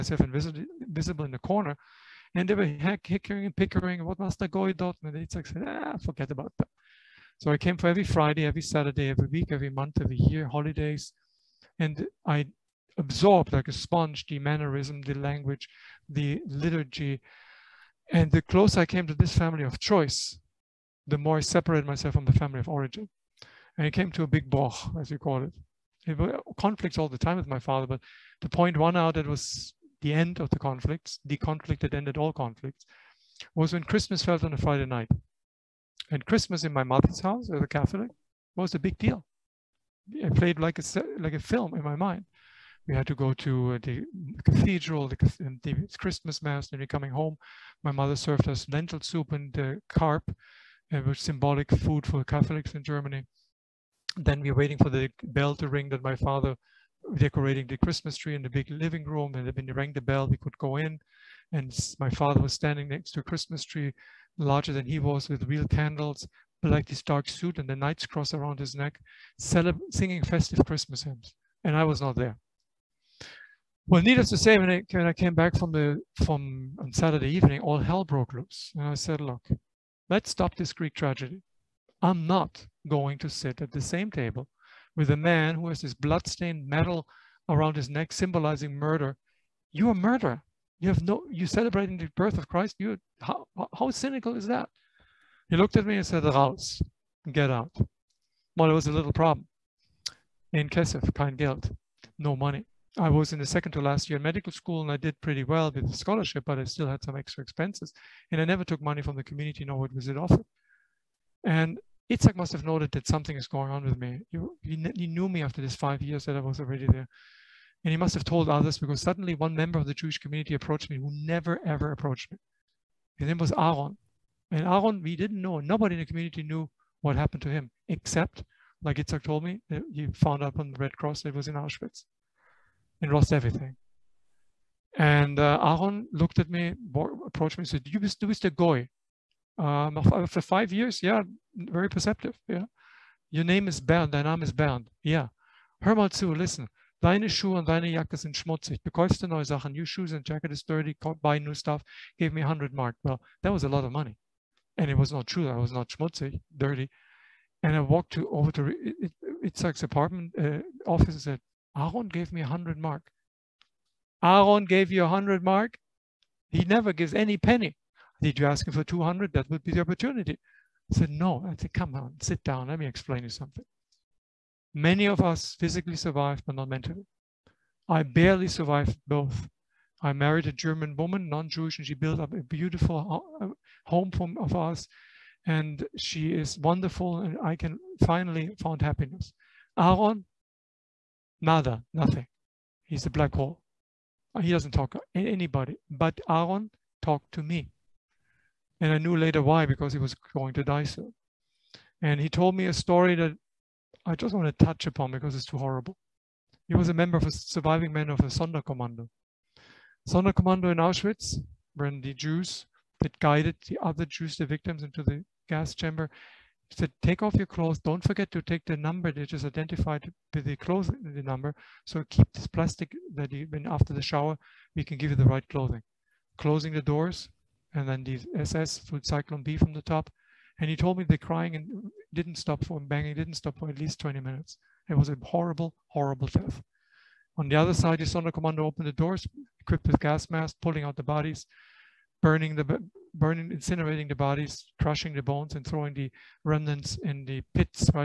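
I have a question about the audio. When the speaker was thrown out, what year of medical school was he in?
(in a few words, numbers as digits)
Second to last year.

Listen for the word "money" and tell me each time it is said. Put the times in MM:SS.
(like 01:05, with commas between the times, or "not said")
01:42, 01:48, 02:33.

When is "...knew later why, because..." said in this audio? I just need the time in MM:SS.
03:18.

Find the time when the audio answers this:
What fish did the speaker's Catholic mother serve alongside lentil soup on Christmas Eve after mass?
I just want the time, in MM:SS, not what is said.
00:49.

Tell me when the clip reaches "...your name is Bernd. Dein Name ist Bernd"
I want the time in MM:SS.
02:23.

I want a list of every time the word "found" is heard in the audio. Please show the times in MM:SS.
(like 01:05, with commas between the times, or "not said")
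02:10, 03:08.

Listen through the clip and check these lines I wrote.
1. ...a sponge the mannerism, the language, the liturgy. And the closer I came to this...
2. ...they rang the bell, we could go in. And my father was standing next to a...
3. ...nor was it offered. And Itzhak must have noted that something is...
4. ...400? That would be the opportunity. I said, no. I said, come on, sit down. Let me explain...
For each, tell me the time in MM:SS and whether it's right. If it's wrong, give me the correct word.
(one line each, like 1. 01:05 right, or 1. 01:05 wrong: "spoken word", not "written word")
1. 00:13 right
2. 00:59 right
3. 01:49 right
4. 02:48 wrong: "200", not "400".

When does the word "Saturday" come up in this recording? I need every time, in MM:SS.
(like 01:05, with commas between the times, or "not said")
00:08, 01:16.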